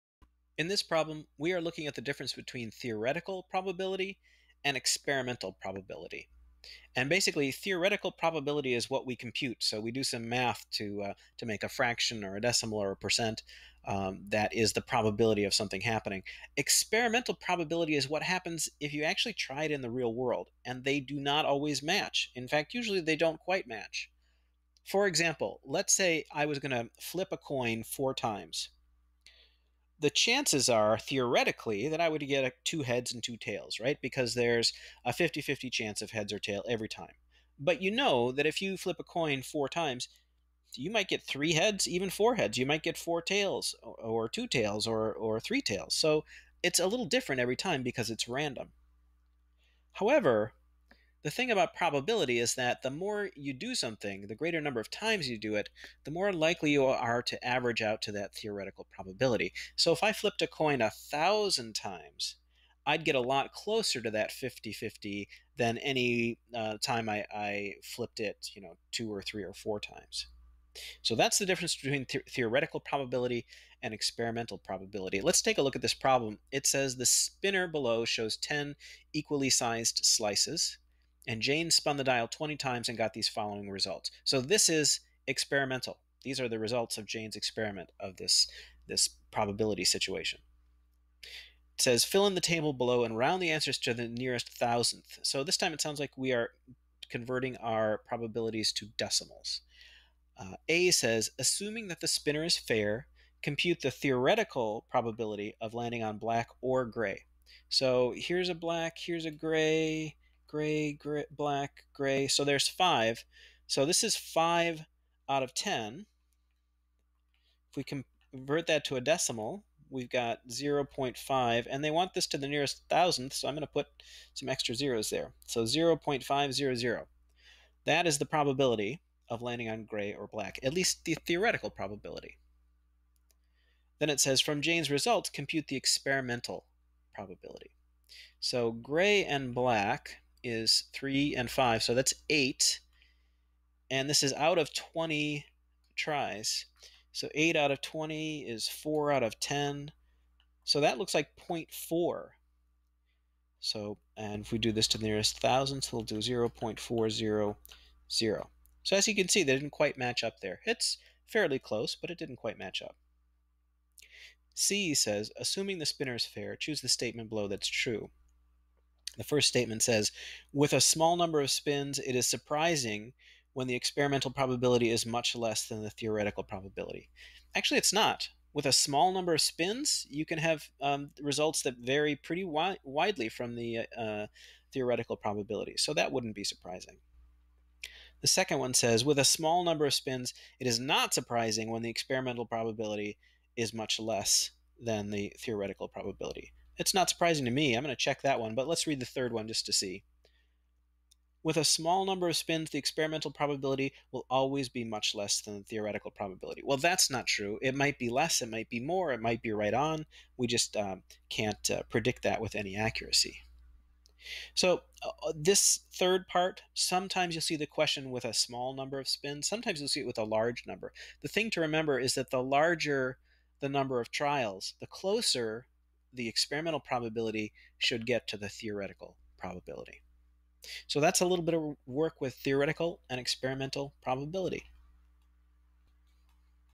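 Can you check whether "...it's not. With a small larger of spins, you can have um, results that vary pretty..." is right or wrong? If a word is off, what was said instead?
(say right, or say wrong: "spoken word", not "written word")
wrong: "number", not "larger".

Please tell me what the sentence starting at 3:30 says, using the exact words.
We just um, can't uh, predict that with any accuracy.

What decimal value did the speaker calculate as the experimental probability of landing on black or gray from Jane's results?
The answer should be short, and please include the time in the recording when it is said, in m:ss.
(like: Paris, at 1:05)
0.400, at 2:36.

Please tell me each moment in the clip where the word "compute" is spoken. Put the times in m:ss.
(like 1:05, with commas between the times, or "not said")
0:09, 1:43, 2:15.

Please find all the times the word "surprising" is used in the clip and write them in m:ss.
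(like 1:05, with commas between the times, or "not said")
2:52, 3:06, 3:11, 3:17.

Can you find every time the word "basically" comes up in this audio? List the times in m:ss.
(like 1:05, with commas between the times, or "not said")
0:07.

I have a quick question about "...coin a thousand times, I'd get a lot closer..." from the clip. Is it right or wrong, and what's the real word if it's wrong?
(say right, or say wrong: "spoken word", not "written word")
right.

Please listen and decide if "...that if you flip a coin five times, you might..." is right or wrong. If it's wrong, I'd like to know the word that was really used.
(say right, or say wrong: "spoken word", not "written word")
wrong: "four", not "five".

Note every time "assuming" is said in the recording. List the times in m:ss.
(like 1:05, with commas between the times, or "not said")
1:41, 2:45.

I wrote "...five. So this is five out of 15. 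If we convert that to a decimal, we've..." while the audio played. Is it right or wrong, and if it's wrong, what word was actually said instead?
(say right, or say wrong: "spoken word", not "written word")
wrong: "10", not "15".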